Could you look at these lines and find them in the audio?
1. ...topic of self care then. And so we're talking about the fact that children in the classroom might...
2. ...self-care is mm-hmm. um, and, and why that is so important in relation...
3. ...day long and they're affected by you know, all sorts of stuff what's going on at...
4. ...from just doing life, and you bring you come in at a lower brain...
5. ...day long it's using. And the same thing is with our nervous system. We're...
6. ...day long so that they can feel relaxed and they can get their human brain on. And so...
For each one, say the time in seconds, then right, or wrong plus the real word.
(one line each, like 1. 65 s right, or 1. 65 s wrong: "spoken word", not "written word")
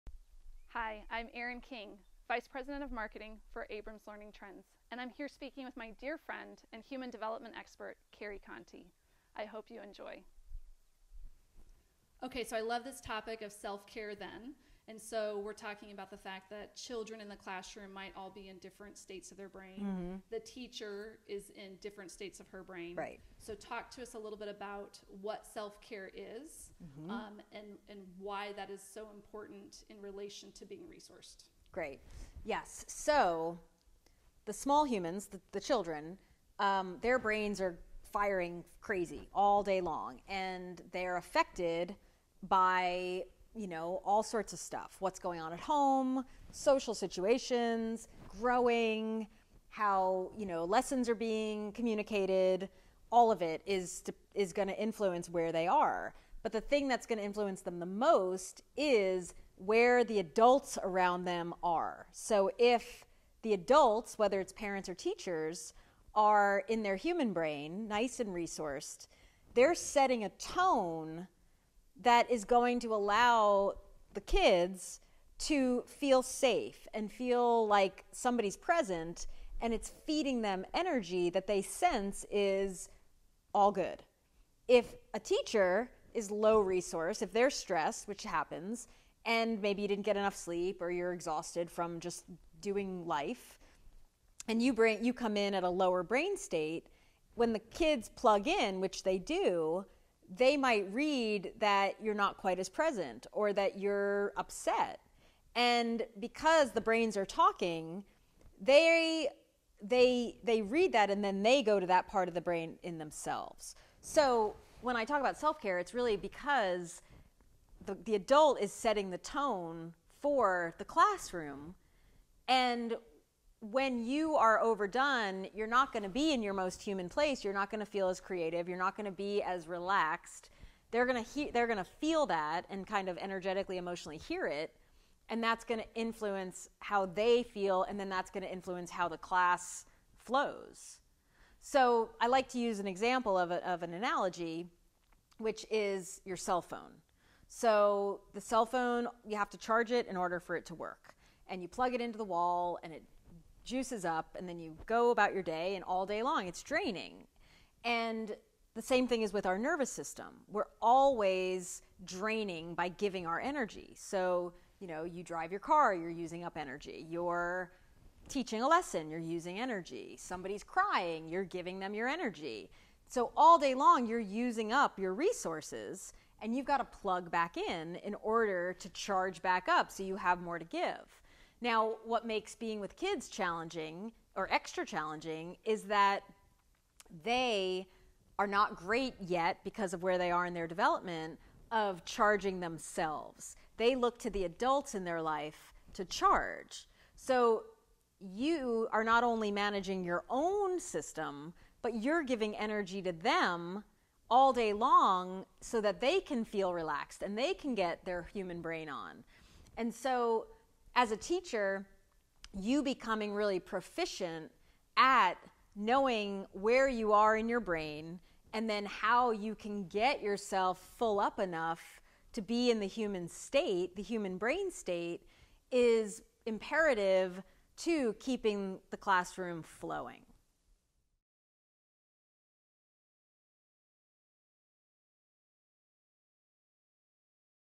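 1. 13 s right
2. 25 s right
3. 39 s right
4. 91 s right
5. 156 s wrong: "draining", not "using"
6. 204 s right.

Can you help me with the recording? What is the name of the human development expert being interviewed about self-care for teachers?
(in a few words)
Carrie Contey.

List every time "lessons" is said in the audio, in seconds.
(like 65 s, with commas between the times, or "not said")
50 s, 168 s.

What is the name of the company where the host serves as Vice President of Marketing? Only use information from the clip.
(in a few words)
Abrams Learning Trends.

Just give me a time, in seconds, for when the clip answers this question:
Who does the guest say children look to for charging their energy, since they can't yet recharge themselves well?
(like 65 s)
194 s.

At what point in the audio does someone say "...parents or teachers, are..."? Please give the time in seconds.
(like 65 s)
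64 s.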